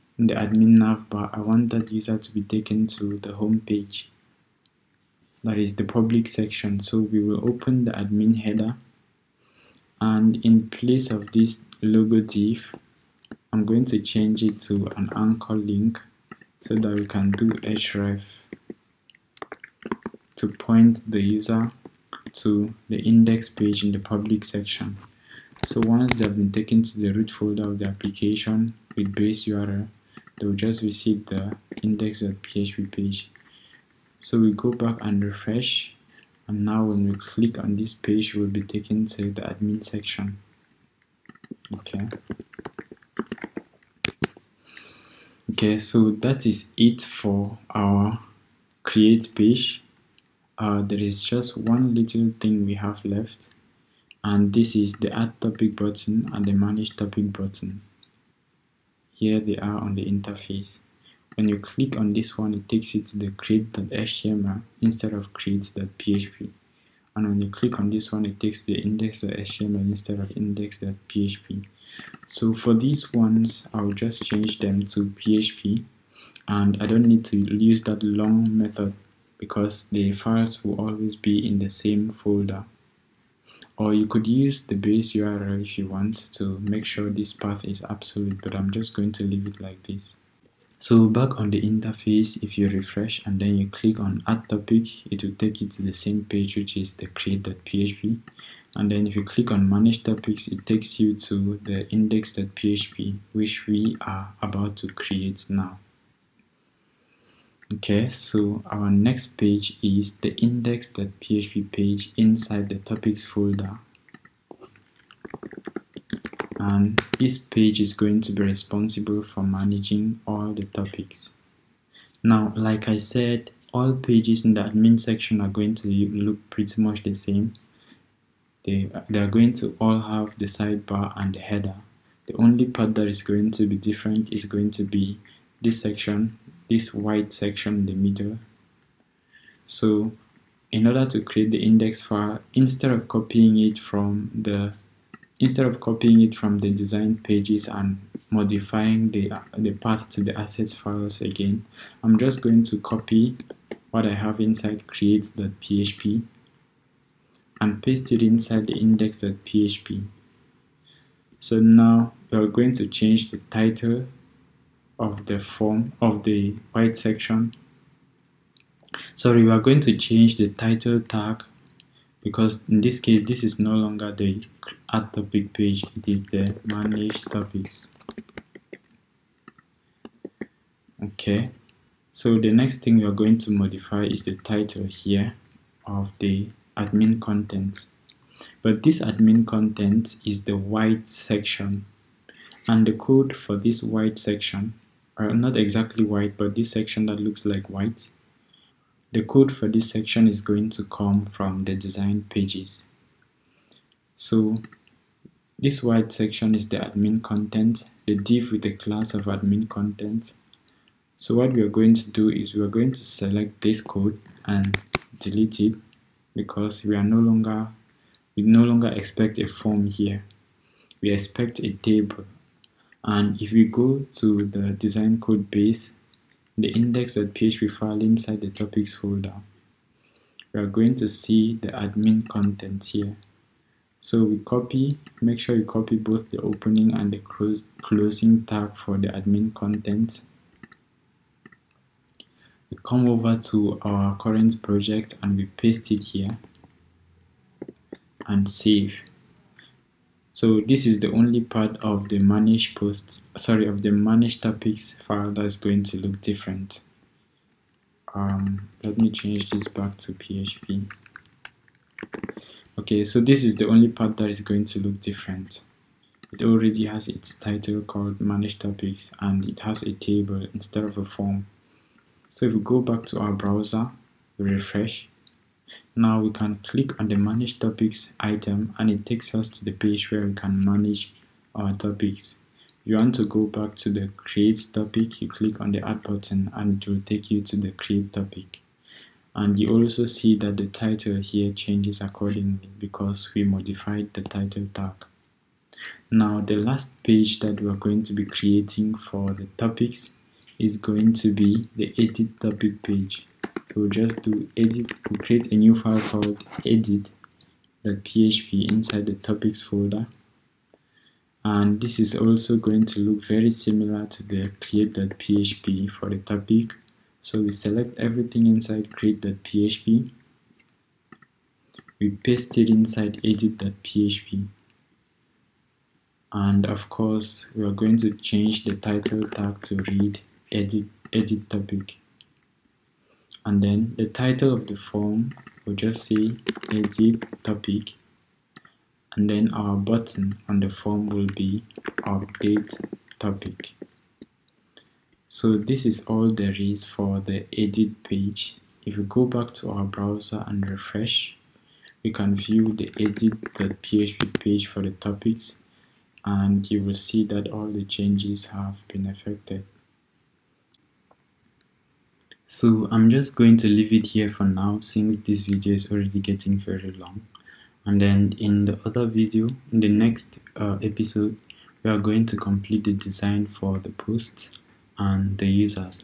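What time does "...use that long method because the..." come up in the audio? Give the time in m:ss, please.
1:17.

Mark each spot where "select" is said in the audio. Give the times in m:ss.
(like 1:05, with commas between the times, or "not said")
3:33, 5:17.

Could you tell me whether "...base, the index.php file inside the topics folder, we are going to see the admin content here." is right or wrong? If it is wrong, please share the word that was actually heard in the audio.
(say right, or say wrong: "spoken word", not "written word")
right.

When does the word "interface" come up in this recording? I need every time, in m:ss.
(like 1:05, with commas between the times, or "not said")
1:00, 1:31.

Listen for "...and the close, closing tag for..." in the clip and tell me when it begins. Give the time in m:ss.
3:56.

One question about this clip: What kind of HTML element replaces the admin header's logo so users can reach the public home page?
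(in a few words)
anchor link.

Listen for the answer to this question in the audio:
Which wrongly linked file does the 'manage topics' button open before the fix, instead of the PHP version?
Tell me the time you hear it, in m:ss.
1:08.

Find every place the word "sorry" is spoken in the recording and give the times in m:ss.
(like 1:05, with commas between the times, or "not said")
2:49, 4:13.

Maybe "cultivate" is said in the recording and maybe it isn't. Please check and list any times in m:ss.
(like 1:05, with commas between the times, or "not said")
not said.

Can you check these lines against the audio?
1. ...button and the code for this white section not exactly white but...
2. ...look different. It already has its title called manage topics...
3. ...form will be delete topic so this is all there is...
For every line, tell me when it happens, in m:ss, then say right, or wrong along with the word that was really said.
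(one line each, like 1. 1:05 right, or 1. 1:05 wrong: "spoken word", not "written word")
1. 3:11 wrong: "section", not "button"
2. 4:24 right
3. 5:40 wrong: "update", not "delete".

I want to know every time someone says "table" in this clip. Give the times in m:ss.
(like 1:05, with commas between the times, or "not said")
3:41, 4:29.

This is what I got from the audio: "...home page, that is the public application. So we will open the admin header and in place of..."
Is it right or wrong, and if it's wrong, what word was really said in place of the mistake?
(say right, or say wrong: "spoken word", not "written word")
wrong: "section", not "application".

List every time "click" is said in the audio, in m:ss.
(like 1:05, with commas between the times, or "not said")
0:37, 1:01, 1:07, 1:33, 1:39, 4:36, 4:45.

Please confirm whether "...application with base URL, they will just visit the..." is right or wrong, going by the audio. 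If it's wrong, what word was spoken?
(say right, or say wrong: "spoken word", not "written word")
right.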